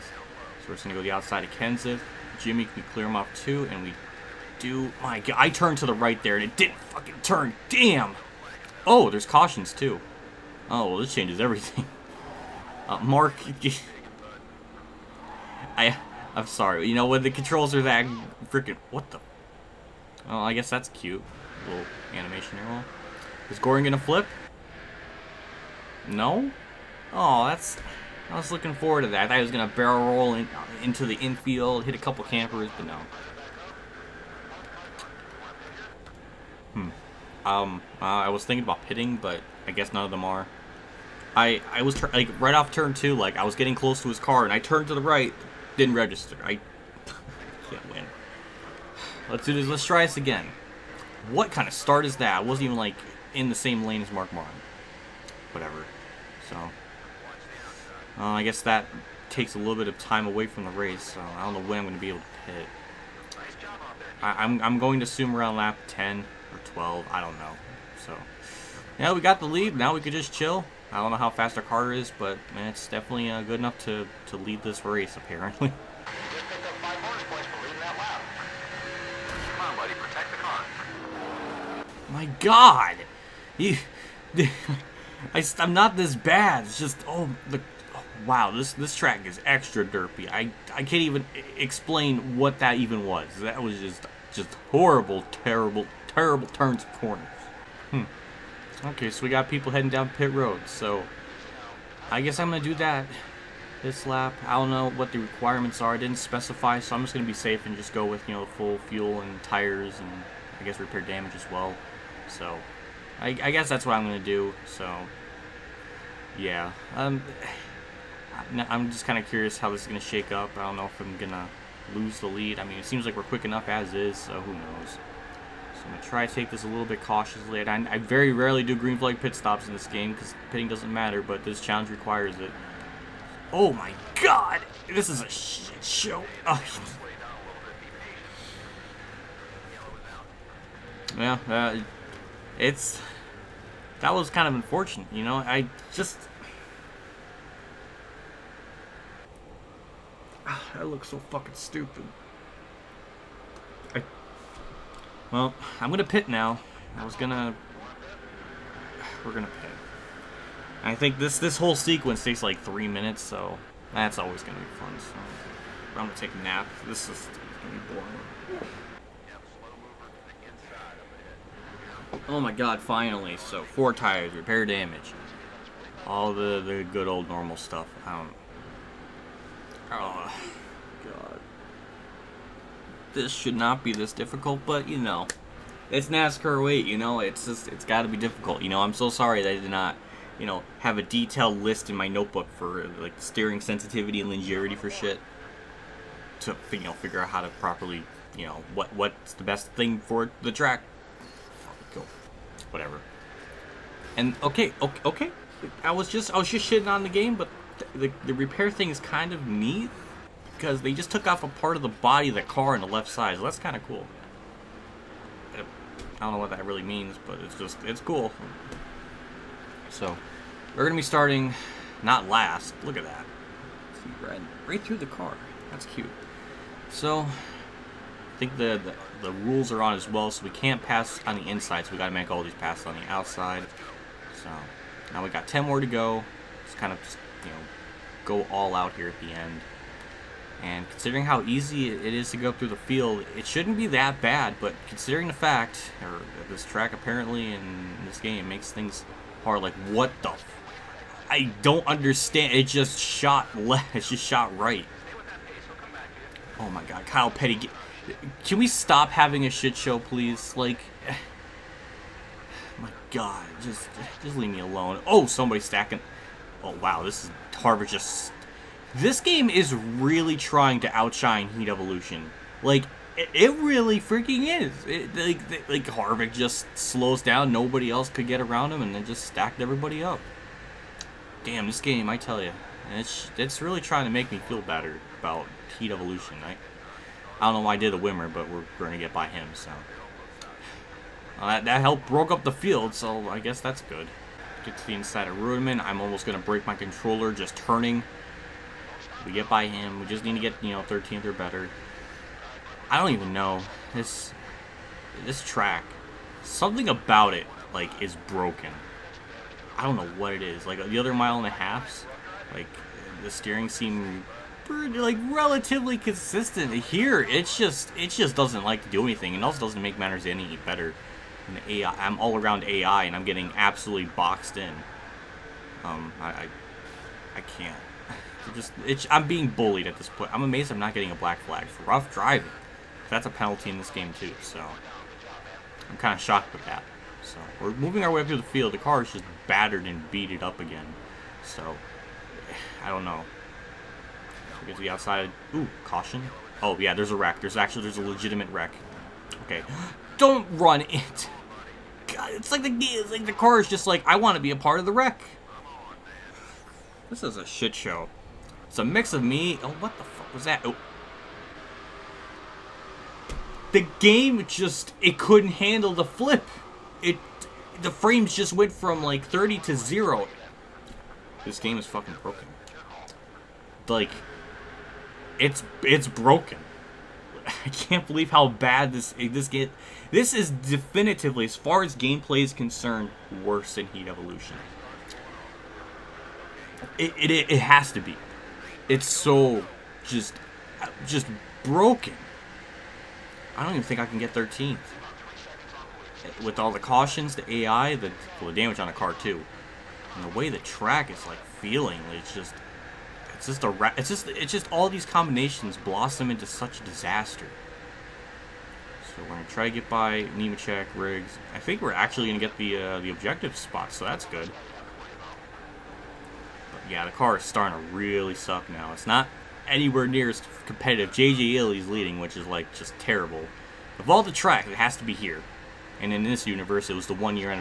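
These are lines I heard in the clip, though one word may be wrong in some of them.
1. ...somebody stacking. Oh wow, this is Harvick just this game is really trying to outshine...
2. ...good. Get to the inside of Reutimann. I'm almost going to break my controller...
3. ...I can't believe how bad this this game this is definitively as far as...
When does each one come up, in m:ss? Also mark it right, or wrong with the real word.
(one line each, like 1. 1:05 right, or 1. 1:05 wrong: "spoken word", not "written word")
1. 4:25 right
2. 4:53 right
3. 6:17 right.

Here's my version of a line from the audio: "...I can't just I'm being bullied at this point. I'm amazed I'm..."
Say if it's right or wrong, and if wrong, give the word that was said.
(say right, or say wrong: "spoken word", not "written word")
right.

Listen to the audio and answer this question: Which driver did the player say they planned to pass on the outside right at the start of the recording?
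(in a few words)
Kenseth.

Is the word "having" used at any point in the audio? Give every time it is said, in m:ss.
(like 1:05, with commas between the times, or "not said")
4:19.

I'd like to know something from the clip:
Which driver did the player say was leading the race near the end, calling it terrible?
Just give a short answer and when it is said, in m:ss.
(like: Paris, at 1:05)
JJ Yeley, at 7:01.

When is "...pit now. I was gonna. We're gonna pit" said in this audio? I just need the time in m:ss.
2:36.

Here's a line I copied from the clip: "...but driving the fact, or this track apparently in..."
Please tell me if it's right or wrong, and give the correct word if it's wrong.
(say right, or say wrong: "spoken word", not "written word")
wrong: "considering", not "driving".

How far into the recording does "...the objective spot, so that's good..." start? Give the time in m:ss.
6:52.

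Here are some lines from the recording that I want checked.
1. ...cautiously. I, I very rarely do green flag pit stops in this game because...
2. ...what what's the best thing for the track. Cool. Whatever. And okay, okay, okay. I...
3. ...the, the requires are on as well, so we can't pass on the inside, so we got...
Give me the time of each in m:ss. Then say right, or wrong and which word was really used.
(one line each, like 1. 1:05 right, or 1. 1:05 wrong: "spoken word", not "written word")
1. 2:07 right
2. 3:18 right
3. 3:48 wrong: "rules", not "requires".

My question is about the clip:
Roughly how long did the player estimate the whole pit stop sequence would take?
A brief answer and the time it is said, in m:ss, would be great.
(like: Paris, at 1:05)
three minutes, at 2:42.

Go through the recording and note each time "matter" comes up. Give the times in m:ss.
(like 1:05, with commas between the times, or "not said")
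2:10, 5:19.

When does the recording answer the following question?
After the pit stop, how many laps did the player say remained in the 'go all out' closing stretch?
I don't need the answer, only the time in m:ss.
3:55.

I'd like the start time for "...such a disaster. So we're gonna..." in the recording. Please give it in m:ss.
6:46.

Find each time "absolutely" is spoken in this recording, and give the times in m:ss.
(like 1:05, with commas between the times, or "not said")
5:23.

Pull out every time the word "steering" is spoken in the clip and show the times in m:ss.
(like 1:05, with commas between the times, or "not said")
3:13, 5:13.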